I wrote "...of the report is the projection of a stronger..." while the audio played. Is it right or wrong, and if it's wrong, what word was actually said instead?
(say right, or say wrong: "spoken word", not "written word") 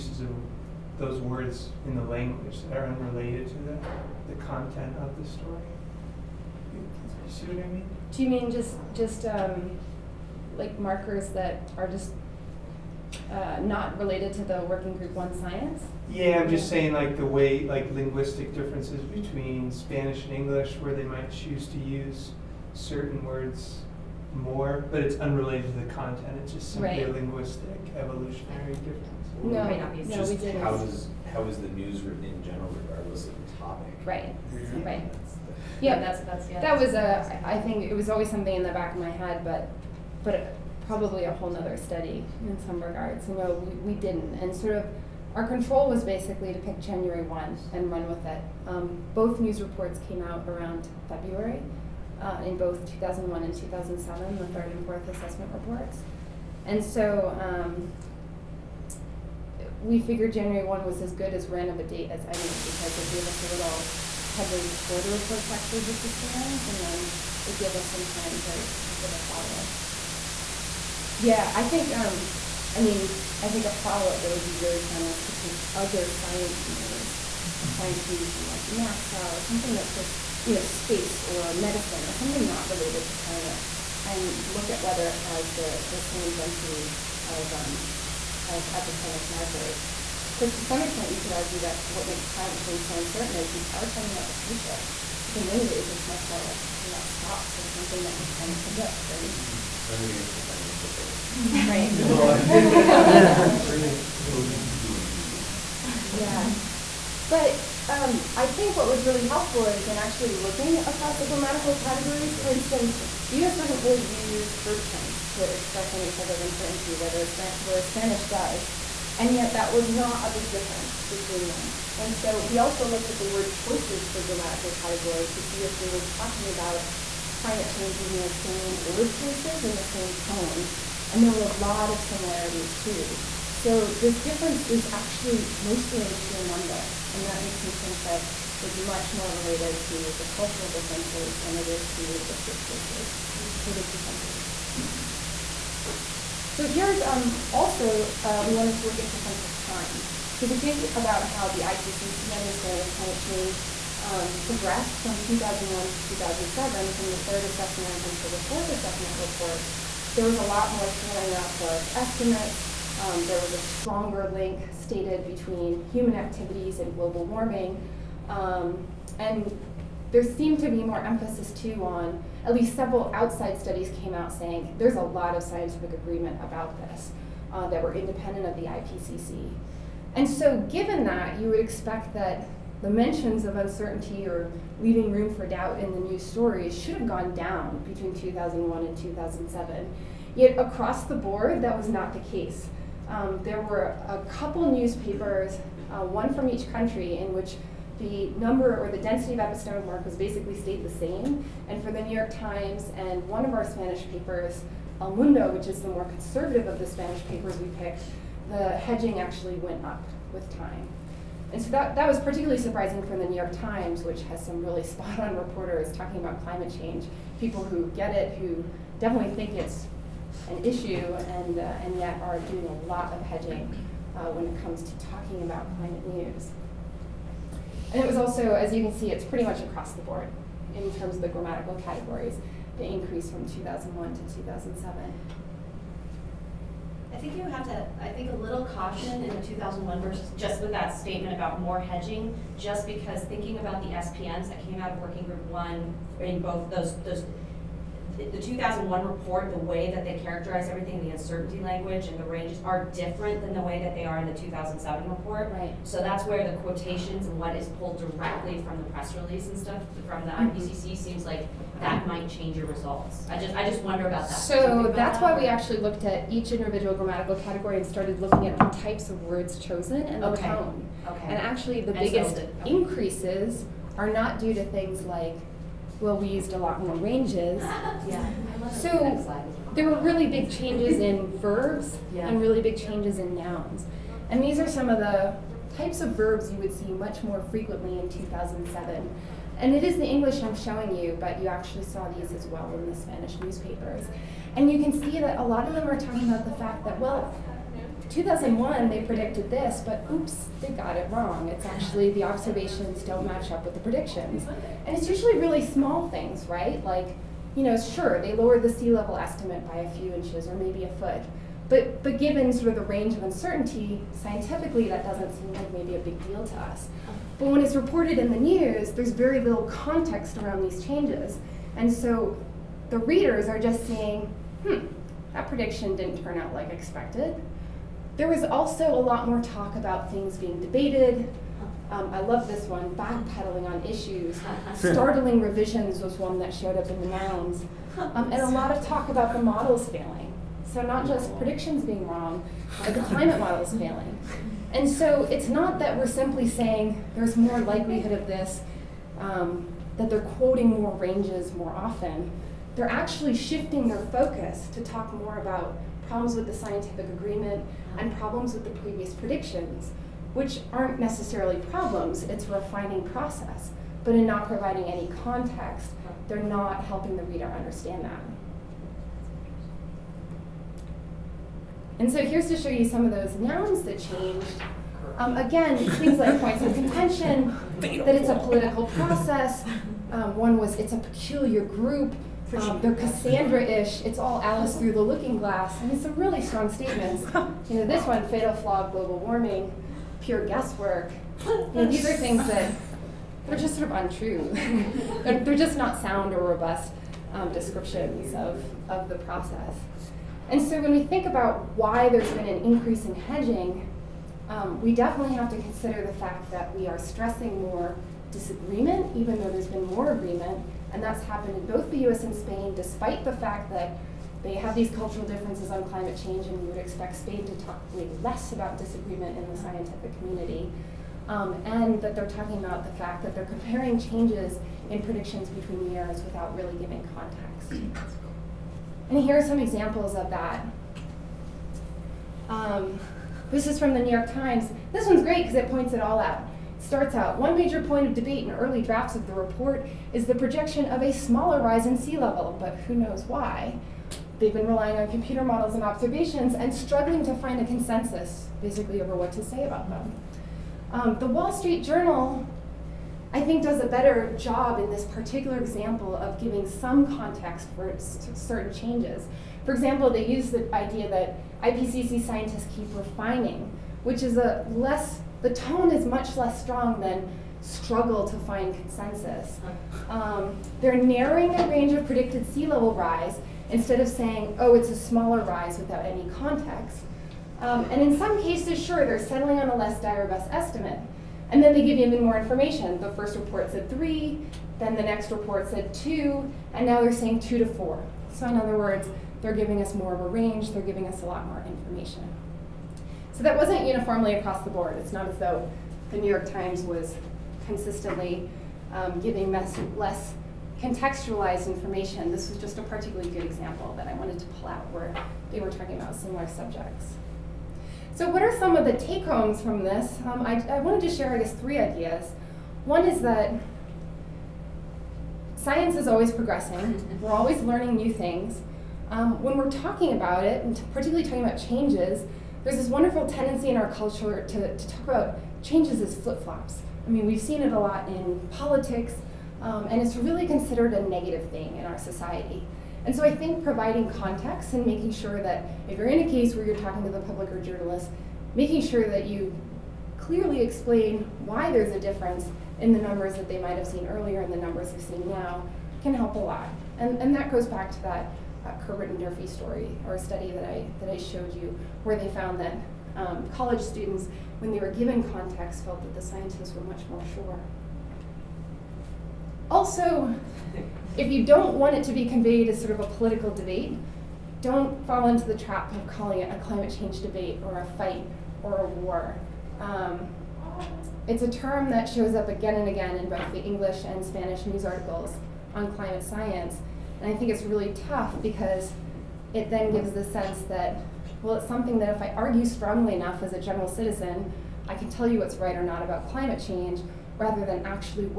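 wrong: "smaller", not "stronger".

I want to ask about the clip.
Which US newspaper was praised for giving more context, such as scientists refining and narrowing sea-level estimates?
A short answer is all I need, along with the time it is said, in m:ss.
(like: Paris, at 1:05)
Wall Street Journal, at 7:31.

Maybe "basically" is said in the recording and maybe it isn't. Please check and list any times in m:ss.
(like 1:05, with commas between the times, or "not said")
0:46, 3:20, 7:28.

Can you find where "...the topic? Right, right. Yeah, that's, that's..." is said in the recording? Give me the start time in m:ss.
0:33.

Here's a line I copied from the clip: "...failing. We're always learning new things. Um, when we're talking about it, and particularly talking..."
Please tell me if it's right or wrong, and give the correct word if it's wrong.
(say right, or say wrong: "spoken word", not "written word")
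wrong: "progressing", not "failing".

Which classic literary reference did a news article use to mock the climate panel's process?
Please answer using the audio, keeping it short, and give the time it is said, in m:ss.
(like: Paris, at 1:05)
Alice through the looking glass, at 6:24.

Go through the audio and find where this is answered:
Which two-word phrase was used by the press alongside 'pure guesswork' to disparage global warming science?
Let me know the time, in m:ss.
6:28.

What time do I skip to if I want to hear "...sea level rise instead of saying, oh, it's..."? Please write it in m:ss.
7:52.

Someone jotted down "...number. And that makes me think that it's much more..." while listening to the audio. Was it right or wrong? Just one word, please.
right.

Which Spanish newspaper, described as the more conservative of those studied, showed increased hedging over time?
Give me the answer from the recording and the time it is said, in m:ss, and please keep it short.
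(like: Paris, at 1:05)
El Mundo, at 3:25.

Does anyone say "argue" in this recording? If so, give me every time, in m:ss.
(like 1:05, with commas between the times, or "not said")
1:31, 9:42.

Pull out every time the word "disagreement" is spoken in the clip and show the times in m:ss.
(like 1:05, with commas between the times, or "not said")
6:48, 6:58.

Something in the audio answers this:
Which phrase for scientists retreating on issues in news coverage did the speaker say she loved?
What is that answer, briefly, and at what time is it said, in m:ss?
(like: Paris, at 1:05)
Backpedaling, at 5:32.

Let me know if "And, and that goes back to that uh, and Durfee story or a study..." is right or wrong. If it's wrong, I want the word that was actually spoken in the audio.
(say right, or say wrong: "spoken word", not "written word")
right.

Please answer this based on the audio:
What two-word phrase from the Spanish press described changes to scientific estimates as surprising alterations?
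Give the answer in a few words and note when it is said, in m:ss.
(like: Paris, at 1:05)
Startling revisions, at 5:34.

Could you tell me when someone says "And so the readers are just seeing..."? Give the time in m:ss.
5:21.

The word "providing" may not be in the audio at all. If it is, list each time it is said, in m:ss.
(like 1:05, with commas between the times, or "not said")
6:04, 8:53.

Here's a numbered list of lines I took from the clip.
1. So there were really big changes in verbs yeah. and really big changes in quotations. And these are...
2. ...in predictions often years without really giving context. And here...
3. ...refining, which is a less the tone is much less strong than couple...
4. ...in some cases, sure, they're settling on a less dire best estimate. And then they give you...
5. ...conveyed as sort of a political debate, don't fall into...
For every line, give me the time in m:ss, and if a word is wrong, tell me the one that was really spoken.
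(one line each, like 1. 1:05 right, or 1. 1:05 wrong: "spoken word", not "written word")
1. 4:38 wrong: "nouns", not "quotations"
2. 7:04 wrong: "between", not "often"
3. 7:42 wrong: "struggle", not "couple"
4. 7:58 right
5. 9:22 right.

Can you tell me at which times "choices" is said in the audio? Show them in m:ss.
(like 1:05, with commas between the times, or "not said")
2:03, 2:09, 2:22.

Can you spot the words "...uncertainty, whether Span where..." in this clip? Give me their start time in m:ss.
1:56.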